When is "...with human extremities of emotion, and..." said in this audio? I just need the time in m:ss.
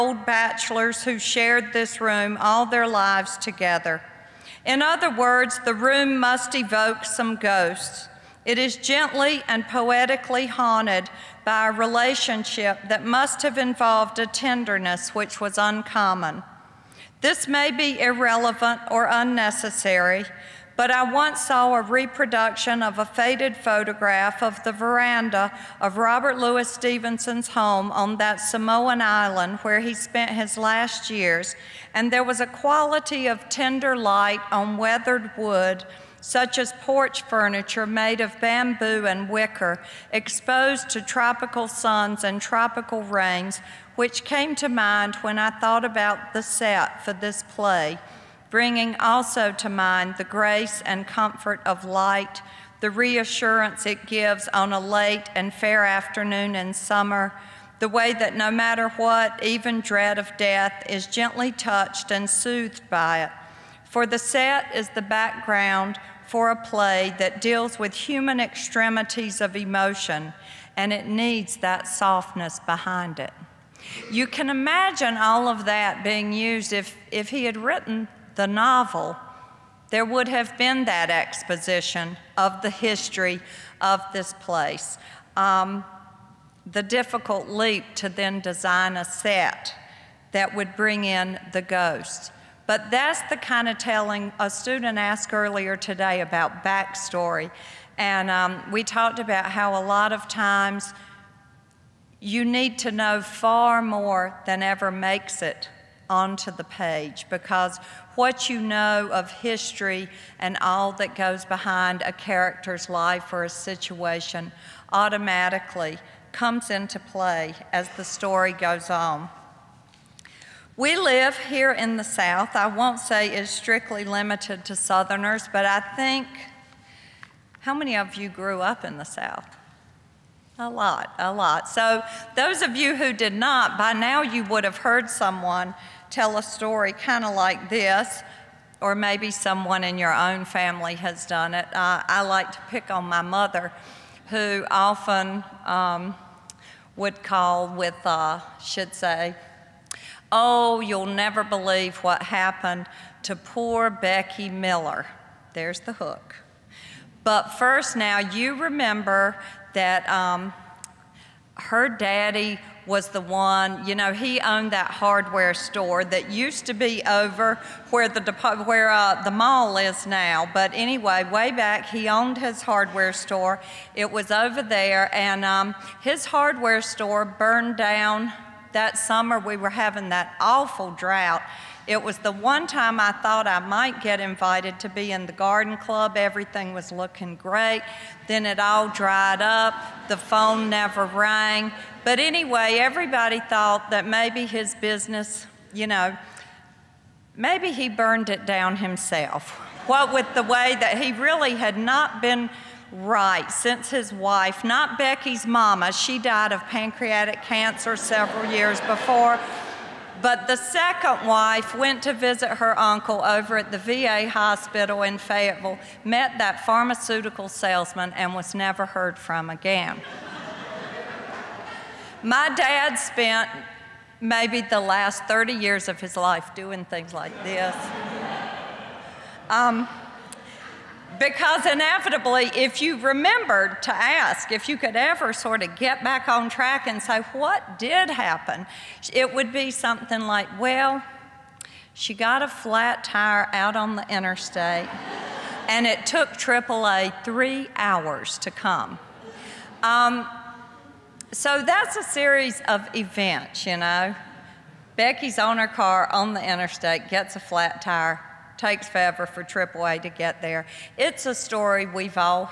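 1:07.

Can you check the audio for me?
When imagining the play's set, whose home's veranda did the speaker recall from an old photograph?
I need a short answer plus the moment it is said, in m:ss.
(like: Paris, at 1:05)
Robert Louis Stevenson, at 0:25.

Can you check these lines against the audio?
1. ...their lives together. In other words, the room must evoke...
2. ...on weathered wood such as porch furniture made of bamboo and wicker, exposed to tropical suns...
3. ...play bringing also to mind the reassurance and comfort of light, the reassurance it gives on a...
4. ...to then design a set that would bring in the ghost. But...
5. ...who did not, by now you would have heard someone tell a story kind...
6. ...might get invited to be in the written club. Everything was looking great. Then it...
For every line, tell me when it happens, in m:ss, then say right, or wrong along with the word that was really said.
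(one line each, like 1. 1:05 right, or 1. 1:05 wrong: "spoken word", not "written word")
1. 0:02 right
2. 0:34 right
3. 0:47 wrong: "grace", not "reassurance"
4. 1:27 right
5. 2:12 right
6. 3:03 wrong: "garden", not "written".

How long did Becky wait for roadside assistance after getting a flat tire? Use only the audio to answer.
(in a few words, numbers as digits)
3 hours.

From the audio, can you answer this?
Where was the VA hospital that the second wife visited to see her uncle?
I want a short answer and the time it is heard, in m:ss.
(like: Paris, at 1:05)
Fayetteville, at 3:35.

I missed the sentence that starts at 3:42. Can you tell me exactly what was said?
My dad spent maybe the last 30 years of his life doing things like this.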